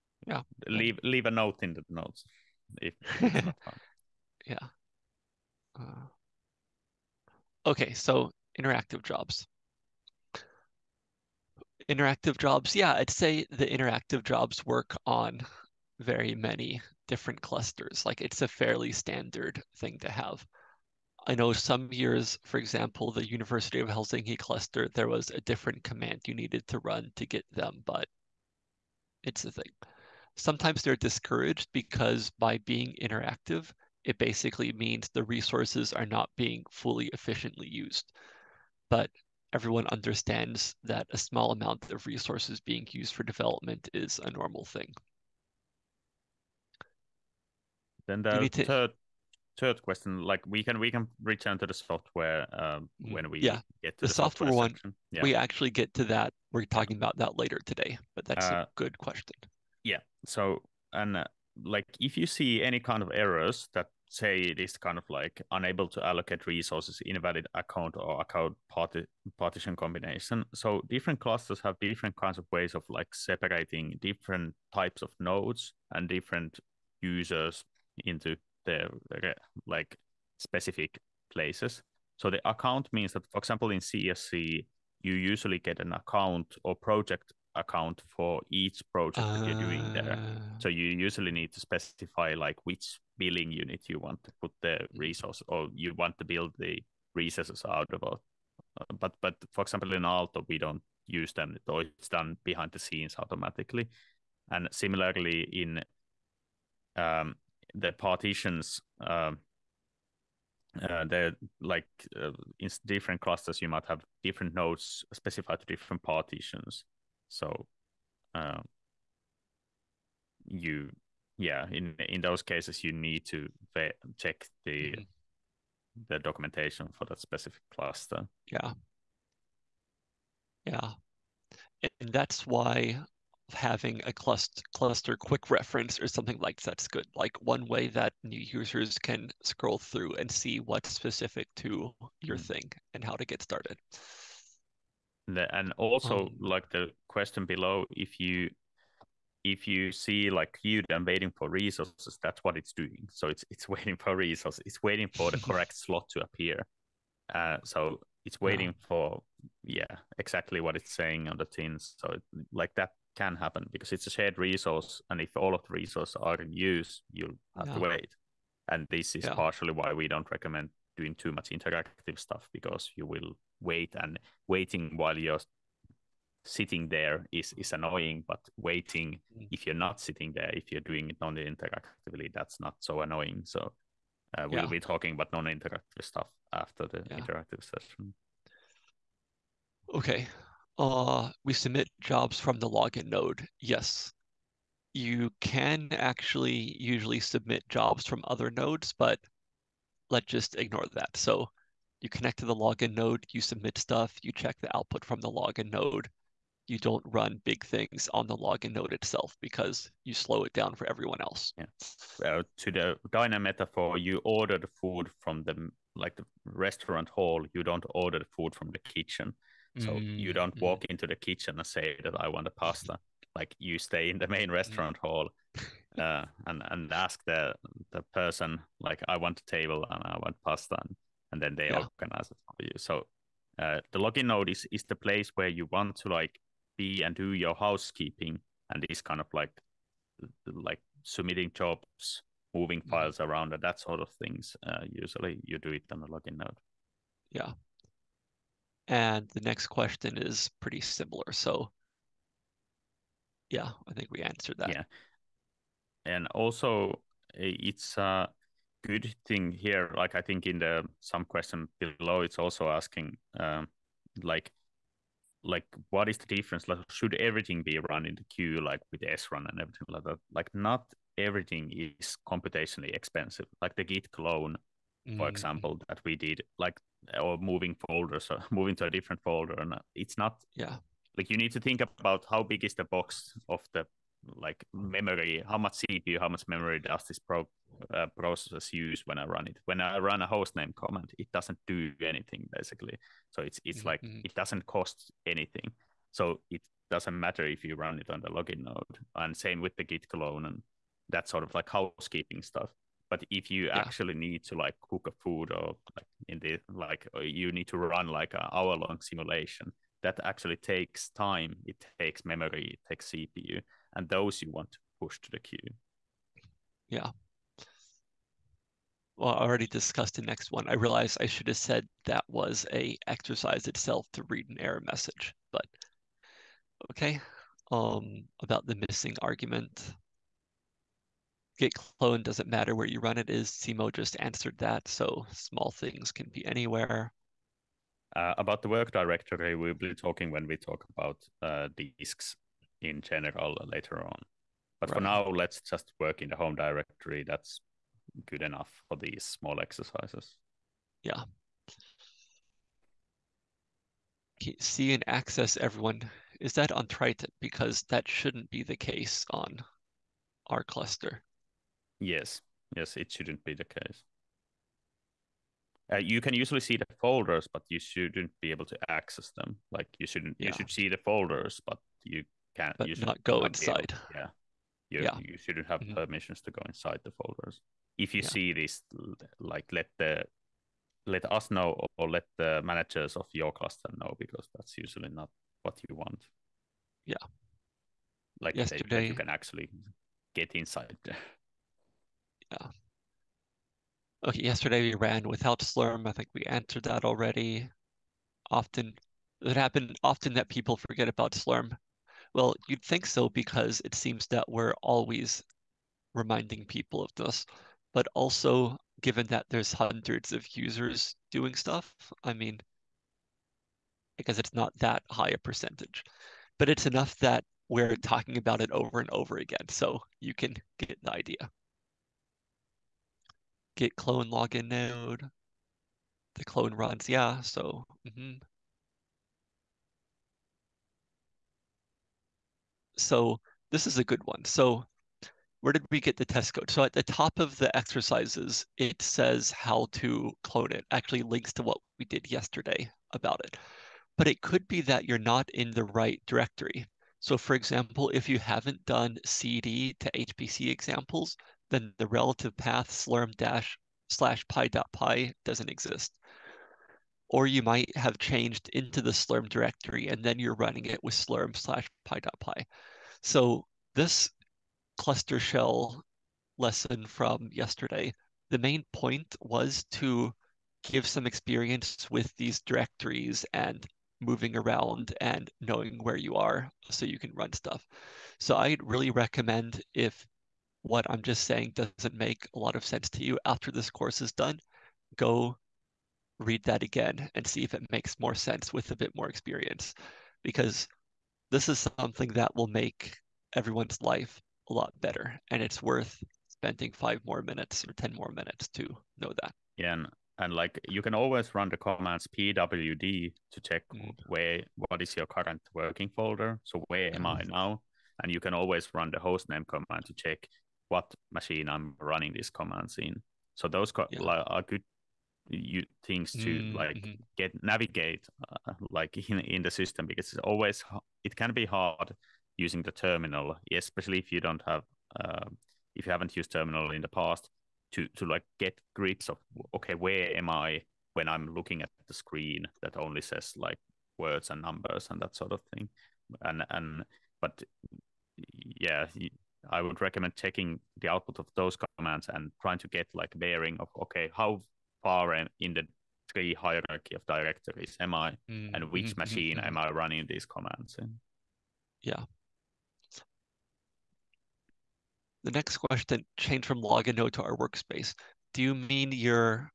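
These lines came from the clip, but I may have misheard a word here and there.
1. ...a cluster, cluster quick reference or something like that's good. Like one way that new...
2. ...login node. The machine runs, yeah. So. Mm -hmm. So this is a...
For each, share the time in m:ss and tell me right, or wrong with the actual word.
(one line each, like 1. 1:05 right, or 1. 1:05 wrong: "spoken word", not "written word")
1. 2:14 right
2. 7:04 wrong: "clone", not "machine".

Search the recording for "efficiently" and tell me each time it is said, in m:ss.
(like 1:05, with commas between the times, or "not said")
0:37.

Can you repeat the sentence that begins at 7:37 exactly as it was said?
Or you might have changed into the slurm directory and then you're running it with slurm slash pi dot pi.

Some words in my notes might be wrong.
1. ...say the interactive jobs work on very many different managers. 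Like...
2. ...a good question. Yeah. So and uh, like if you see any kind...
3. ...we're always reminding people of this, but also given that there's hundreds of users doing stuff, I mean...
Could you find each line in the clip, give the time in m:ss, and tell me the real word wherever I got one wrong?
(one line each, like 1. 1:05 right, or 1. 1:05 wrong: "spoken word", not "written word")
1. 0:13 wrong: "clusters", not "managers"
2. 0:58 right
3. 6:44 right.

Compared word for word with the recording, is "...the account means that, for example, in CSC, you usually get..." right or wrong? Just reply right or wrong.
right.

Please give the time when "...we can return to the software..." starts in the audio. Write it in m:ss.
0:50.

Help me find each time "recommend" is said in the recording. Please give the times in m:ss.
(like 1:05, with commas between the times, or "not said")
2:50, 7:59, 9:00.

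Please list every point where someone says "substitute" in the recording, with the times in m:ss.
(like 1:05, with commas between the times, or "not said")
not said.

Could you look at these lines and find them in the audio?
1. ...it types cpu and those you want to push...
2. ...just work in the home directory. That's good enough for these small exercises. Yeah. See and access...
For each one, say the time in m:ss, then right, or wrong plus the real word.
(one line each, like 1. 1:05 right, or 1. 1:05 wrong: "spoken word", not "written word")
1. 5:12 wrong: "takes", not "types"
2. 5:45 right.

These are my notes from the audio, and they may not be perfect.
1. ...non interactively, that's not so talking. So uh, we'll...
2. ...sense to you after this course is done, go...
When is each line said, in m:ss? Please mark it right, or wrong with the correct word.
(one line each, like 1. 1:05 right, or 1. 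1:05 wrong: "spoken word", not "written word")
1. 3:01 wrong: "annoying", not "talking"
2. 8:02 right.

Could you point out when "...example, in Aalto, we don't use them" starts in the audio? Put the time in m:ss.
1:39.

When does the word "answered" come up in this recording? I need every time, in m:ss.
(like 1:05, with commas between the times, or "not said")
4:14, 5:34, 6:36.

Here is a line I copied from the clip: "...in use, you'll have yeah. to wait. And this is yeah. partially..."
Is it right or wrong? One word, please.
right.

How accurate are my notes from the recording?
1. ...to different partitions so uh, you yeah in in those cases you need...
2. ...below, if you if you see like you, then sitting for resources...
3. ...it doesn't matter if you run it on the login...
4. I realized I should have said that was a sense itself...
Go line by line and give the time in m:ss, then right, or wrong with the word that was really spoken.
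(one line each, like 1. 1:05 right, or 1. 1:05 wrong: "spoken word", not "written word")
1. 1:55 right
2. 2:27 wrong: "waiting", not "sitting"
3. 4:56 right
4. 5:20 wrong: "exercise", not "sense".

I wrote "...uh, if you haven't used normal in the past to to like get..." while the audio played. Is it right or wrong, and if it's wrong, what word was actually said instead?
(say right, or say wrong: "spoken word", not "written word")
wrong: "terminal", not "normal".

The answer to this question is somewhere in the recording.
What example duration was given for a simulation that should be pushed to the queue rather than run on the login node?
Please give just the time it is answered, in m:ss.
5:08.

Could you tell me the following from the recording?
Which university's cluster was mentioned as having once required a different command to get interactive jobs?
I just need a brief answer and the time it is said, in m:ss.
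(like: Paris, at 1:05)
University of Helsinki, at 0:23.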